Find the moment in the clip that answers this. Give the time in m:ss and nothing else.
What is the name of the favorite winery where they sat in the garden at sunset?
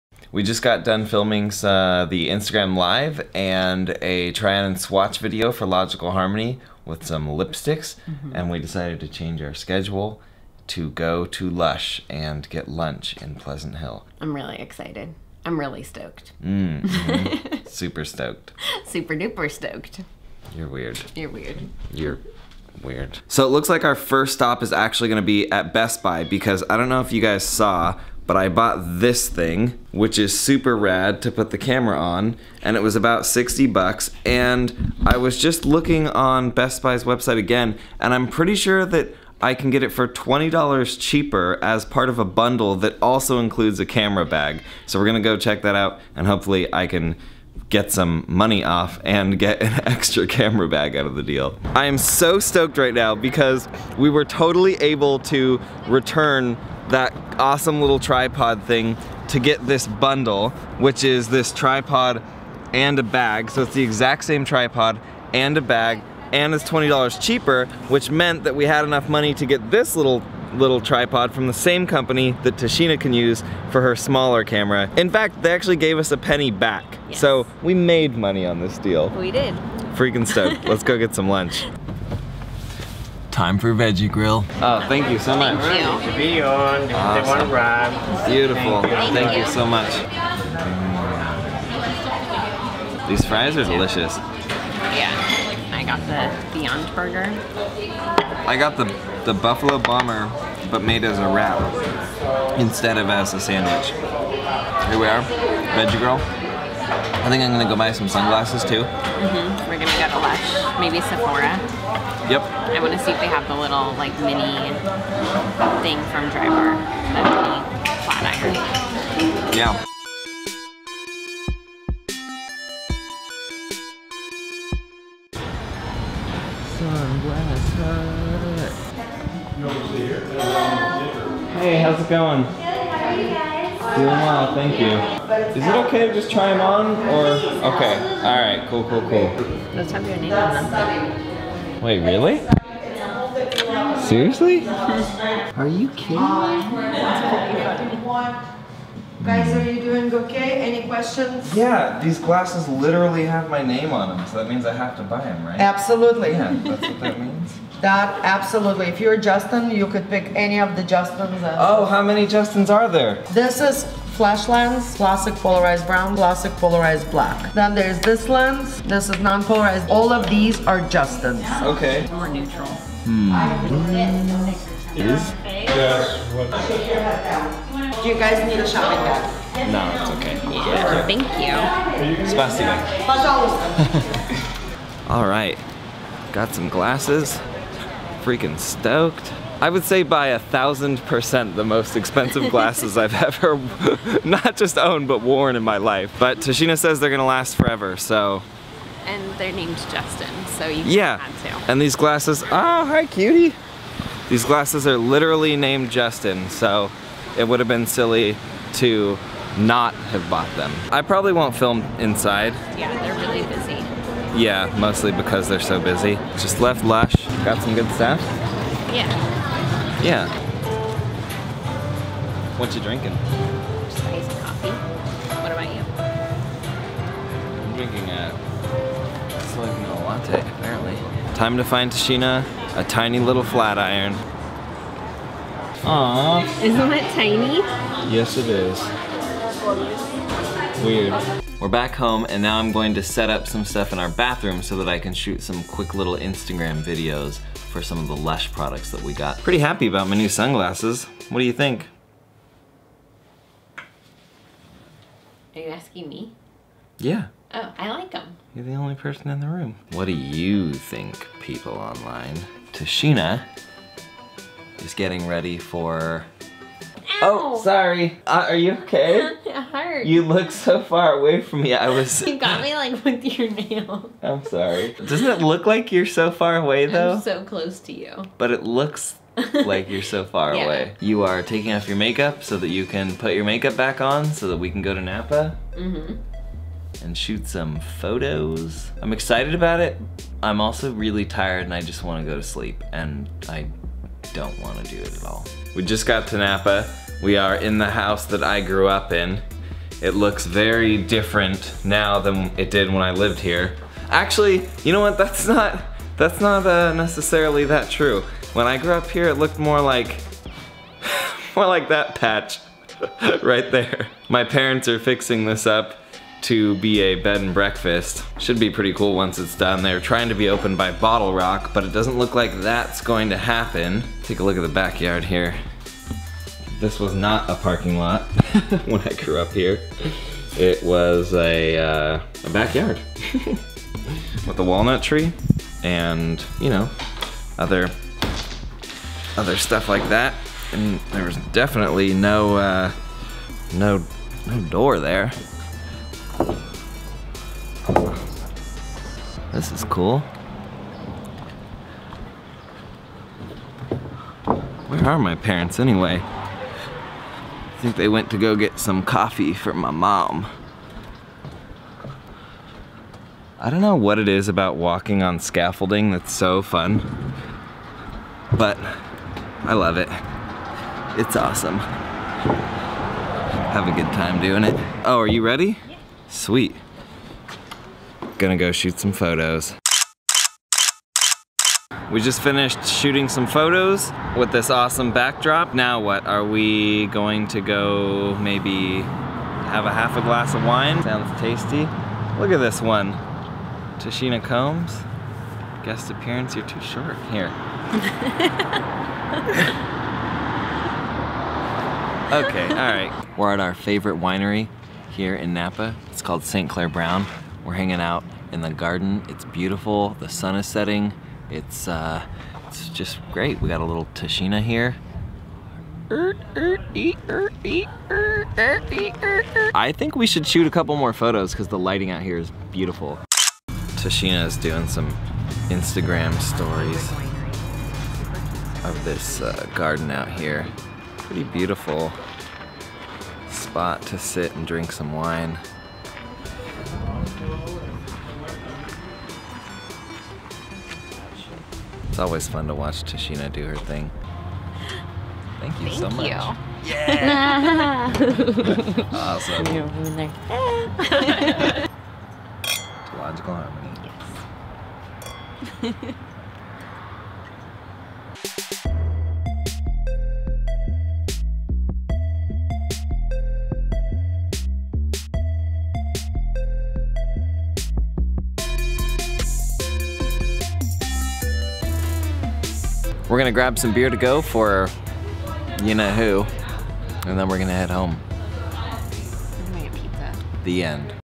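6:46.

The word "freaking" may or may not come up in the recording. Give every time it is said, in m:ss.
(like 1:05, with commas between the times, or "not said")
1:19, 3:08.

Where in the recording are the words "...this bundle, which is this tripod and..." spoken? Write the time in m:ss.
0:59.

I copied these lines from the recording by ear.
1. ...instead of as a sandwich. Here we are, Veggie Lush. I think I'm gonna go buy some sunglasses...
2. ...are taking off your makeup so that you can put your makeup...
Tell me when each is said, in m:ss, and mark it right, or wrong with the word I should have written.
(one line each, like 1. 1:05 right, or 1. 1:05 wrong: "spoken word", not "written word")
1. 1:42 wrong: "Grill", not "Lush"
2. 4:41 right.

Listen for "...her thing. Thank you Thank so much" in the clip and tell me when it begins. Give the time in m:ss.
7:23.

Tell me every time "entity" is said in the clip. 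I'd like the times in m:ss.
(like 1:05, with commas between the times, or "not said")
not said.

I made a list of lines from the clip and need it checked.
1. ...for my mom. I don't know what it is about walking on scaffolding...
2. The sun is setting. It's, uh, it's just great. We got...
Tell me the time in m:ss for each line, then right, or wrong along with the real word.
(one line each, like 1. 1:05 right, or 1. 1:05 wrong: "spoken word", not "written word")
1. 5:59 right
2. 6:50 right.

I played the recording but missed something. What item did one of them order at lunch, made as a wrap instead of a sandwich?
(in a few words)
Buffalo Bomber.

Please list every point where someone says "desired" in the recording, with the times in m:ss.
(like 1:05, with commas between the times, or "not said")
not said.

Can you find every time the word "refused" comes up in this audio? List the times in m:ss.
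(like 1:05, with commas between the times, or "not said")
not said.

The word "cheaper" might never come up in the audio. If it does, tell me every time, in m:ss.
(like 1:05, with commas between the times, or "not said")
0:40, 1:07.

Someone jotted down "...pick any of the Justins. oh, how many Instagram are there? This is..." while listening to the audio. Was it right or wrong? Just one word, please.
wrong.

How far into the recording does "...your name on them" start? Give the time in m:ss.
2:20.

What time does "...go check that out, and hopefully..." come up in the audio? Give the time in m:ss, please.
0:45.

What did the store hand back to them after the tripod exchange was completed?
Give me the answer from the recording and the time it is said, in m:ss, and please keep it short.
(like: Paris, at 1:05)
A penny, at 1:16.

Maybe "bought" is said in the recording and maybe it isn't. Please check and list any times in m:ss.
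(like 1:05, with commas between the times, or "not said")
0:28, 3:30.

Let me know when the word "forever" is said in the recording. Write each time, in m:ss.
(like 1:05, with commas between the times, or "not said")
3:17.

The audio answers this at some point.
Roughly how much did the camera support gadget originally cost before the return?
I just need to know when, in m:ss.
0:33.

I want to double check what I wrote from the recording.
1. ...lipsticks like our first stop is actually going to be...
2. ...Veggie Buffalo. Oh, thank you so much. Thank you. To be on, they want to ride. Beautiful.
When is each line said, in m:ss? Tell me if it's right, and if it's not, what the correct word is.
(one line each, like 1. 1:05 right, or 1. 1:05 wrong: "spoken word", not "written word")
1. 0:23 wrong: "looks", not "lipsticks"
2. 1:23 wrong: "Grill", not "Buffalo".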